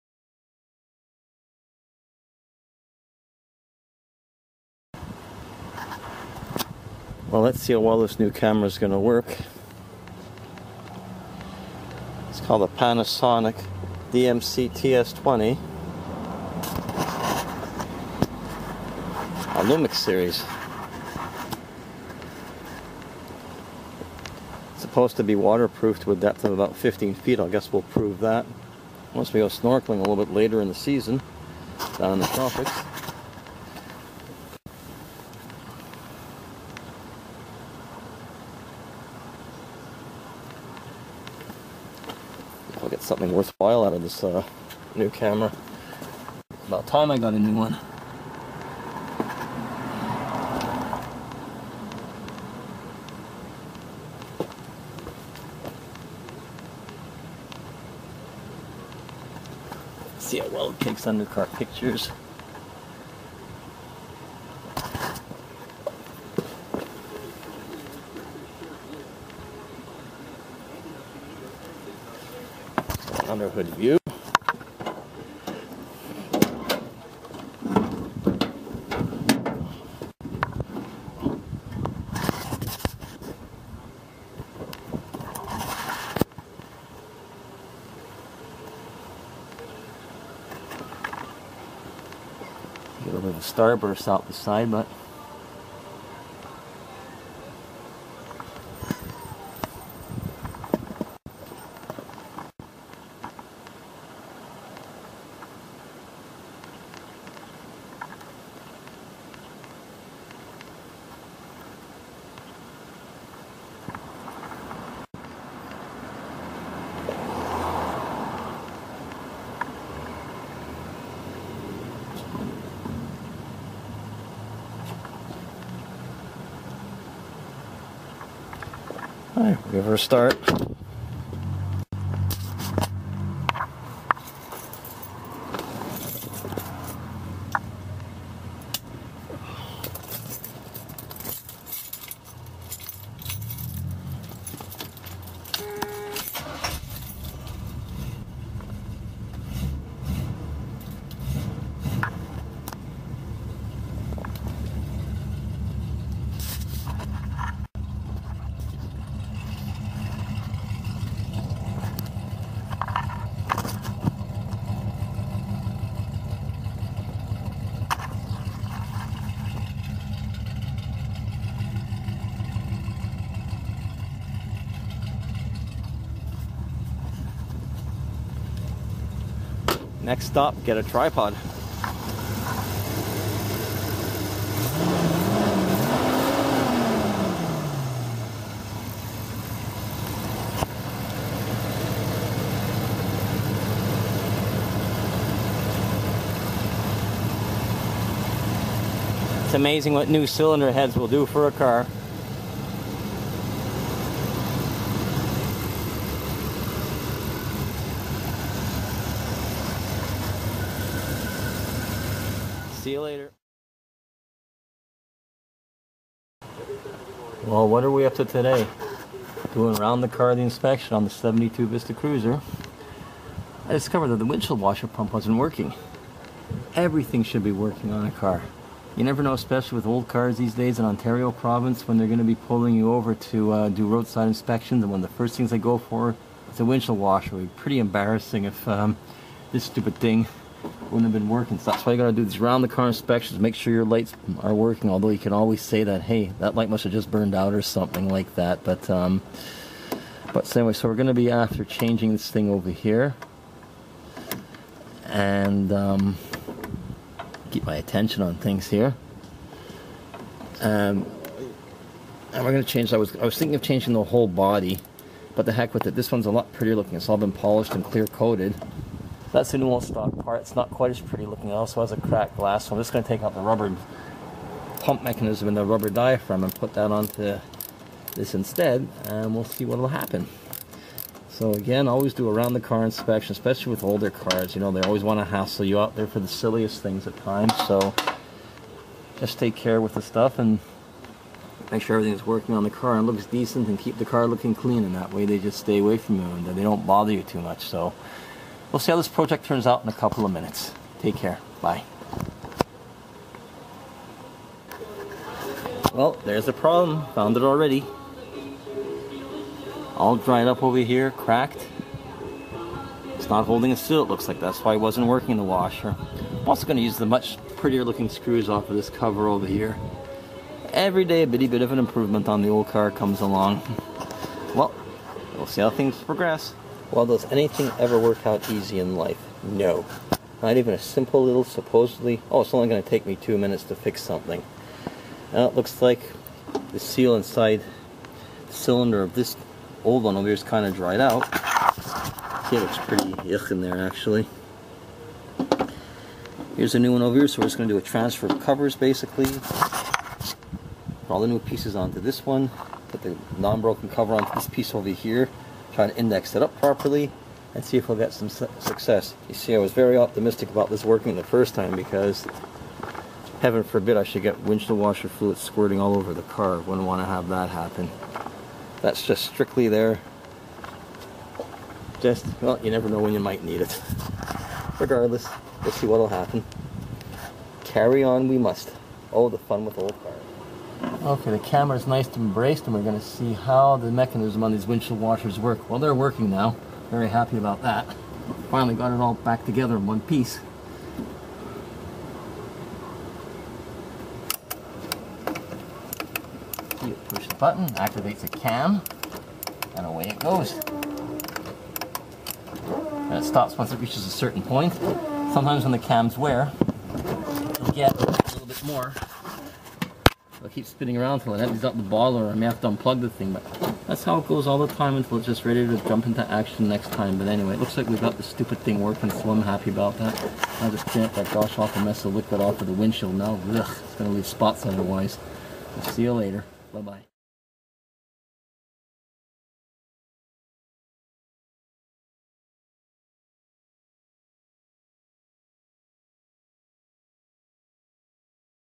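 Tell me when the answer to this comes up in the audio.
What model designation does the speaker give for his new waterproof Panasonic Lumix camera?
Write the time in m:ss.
0:14.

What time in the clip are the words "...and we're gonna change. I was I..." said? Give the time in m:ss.
4:22.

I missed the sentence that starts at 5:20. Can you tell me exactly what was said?
Every day a bitty bit of an improvement on the old car comes along.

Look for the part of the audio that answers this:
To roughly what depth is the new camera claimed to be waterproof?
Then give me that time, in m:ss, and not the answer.
0:26.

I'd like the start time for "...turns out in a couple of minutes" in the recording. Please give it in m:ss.
4:59.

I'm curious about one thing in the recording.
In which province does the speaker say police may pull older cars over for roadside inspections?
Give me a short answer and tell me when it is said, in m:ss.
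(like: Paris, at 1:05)
Ontario, at 3:50.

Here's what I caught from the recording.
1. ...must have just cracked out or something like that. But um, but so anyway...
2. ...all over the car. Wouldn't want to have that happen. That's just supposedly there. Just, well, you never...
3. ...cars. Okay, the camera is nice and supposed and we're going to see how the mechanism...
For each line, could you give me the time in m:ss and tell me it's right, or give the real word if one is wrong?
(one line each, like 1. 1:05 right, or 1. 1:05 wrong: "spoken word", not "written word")
1. 4:06 wrong: "burned", not "cracked"
2. 6:05 wrong: "strictly", not "supposedly"
3. 6:20 wrong: "embraced", not "supposed".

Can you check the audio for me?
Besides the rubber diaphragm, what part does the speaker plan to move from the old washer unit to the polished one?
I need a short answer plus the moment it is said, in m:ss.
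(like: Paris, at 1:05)
rubber pump mechanism, at 4:33.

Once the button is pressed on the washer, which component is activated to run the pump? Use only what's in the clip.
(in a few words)
The cam.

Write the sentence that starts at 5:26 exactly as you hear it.
Well, does anything ever work out easy in life?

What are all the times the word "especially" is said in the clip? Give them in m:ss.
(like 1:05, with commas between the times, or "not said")
3:49, 4:43.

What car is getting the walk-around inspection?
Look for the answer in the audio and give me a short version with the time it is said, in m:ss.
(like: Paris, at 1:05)
1972 Vista Cruiser, at 3:41.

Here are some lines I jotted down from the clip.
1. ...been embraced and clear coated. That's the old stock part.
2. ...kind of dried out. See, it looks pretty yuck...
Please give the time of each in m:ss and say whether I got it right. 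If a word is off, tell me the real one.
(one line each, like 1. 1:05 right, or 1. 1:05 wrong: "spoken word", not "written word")
1. 4:27 wrong: "polished", not "embraced"
2. 5:40 right.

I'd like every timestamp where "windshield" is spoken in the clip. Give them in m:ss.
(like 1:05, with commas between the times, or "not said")
3:44, 3:56, 6:04, 6:24, 7:02.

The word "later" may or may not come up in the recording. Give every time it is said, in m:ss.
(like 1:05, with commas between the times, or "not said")
0:30, 3:33, 7:06.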